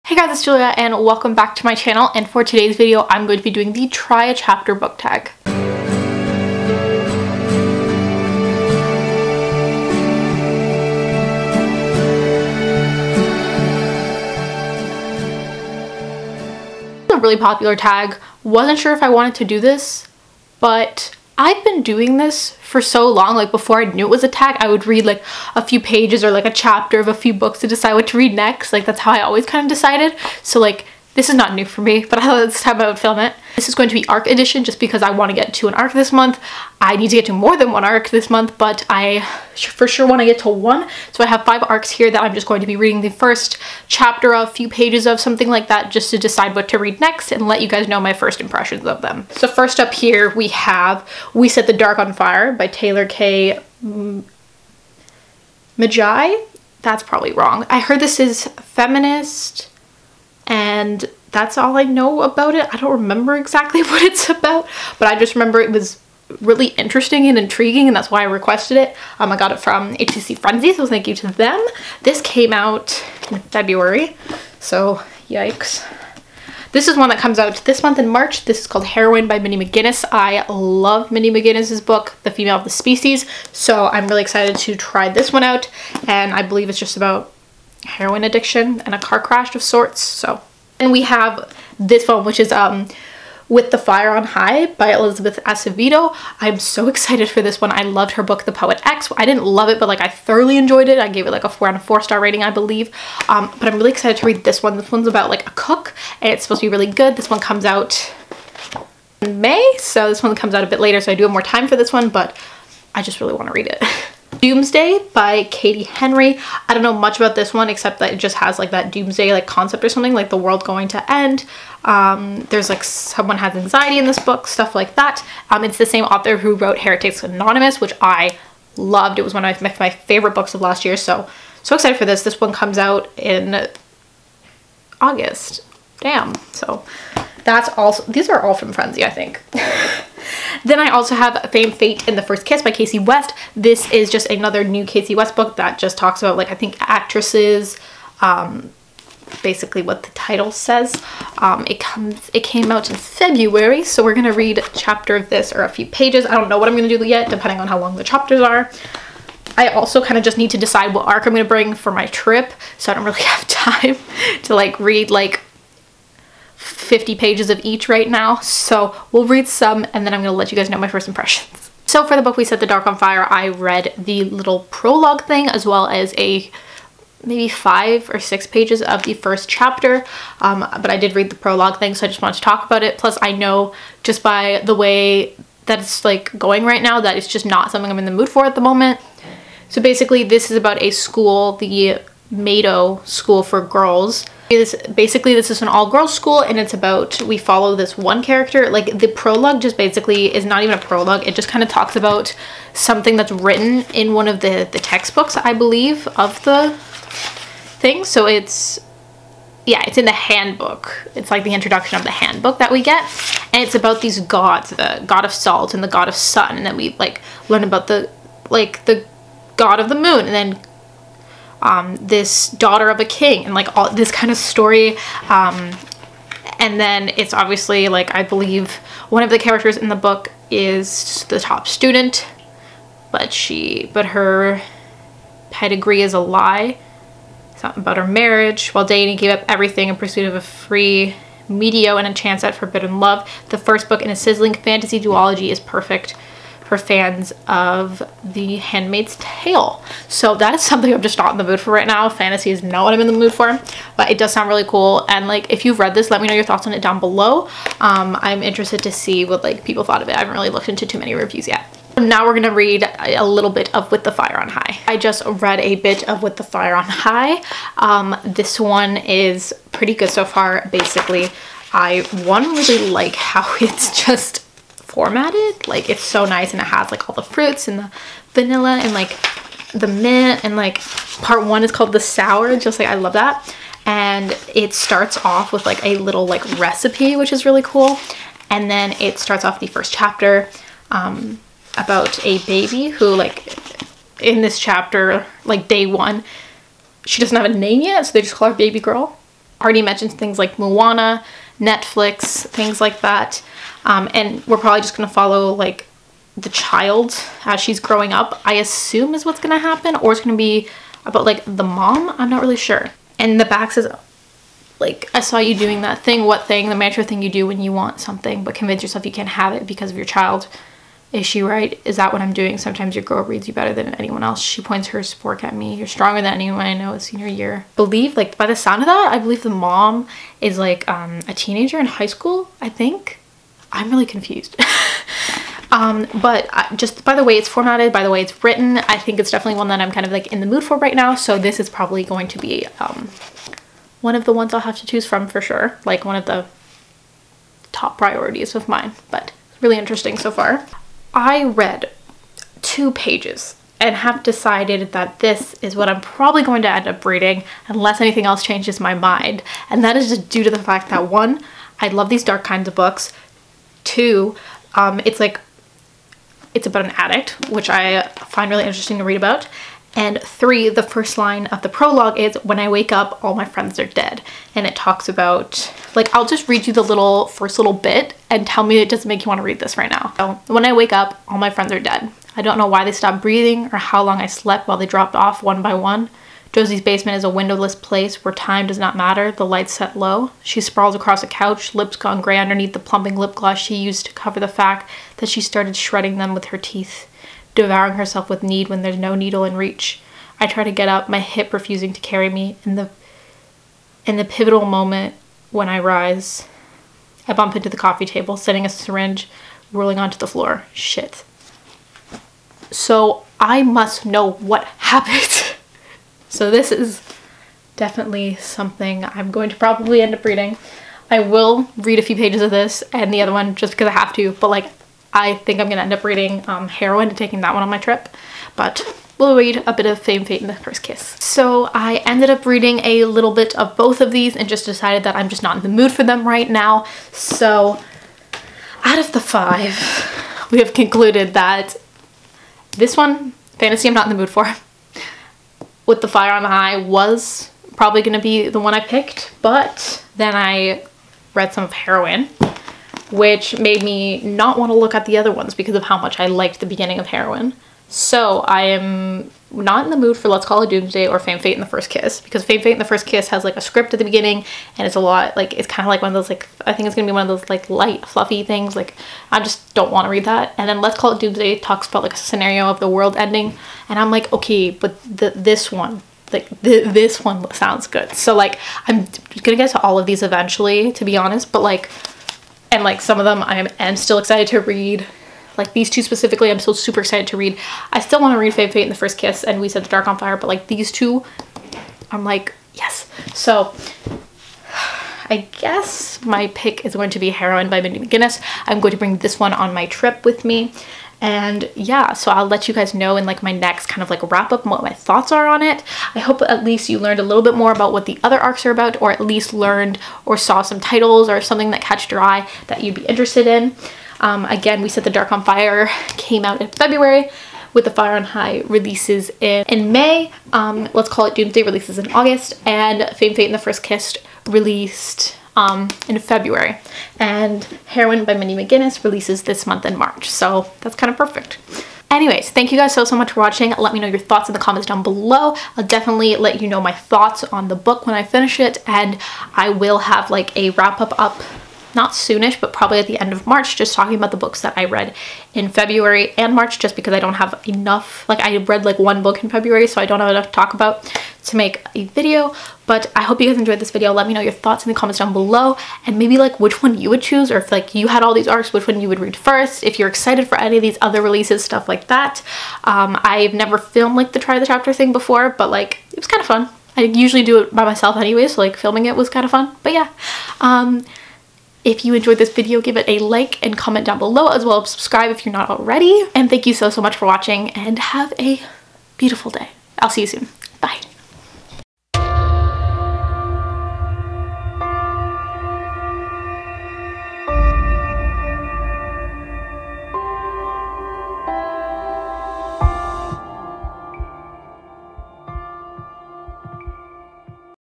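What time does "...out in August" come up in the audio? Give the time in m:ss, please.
2:12.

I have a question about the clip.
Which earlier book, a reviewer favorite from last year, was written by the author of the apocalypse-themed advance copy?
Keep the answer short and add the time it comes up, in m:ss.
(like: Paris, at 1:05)
Heretics Anonymous, at 2:06.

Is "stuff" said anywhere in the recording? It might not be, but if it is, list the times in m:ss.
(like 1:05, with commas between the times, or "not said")
2:04, 9:21.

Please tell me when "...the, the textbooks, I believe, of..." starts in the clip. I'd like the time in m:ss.
3:24.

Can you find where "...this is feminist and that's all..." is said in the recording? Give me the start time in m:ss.
0:57.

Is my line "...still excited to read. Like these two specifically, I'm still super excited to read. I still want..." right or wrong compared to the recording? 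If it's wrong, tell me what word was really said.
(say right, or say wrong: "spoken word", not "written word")
right.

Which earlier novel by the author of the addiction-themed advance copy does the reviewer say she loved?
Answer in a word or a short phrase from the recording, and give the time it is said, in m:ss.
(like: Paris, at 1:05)
The Female of the Species, at 1:22.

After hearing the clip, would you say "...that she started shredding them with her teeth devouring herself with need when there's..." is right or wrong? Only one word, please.
right.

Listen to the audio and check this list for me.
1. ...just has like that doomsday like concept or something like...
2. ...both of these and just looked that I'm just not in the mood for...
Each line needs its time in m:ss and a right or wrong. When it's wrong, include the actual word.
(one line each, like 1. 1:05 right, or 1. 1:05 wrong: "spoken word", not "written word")
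1. 1:58 right
2. 7:13 wrong: "decided", not "looked".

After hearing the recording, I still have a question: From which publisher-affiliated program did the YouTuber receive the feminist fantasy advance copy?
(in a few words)
HCC Frenzy.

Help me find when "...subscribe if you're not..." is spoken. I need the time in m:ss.
9:34.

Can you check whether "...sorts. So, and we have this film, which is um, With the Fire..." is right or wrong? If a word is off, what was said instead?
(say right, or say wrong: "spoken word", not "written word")
right.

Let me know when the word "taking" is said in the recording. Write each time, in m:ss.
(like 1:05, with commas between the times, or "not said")
7:07.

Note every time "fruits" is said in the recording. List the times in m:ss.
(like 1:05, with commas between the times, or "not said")
4:37.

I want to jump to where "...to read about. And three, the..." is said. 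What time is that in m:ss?
6:08.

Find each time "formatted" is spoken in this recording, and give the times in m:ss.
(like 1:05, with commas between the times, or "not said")
4:34, 5:37.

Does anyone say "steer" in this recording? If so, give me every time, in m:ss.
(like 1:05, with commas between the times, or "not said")
not said.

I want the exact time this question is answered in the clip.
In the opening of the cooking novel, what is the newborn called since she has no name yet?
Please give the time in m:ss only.
4:58.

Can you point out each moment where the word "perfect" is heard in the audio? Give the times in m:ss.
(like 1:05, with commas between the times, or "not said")
4:05, 8:51.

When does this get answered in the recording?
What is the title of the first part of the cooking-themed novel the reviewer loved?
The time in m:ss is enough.
4:41.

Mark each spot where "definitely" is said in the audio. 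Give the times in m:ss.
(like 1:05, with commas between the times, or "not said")
5:39, 6:57, 8:55.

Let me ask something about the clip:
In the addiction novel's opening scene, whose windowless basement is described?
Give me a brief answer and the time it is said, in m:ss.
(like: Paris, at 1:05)
Josie's, at 6:26.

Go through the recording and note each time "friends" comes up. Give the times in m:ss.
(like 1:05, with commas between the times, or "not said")
6:13, 6:21.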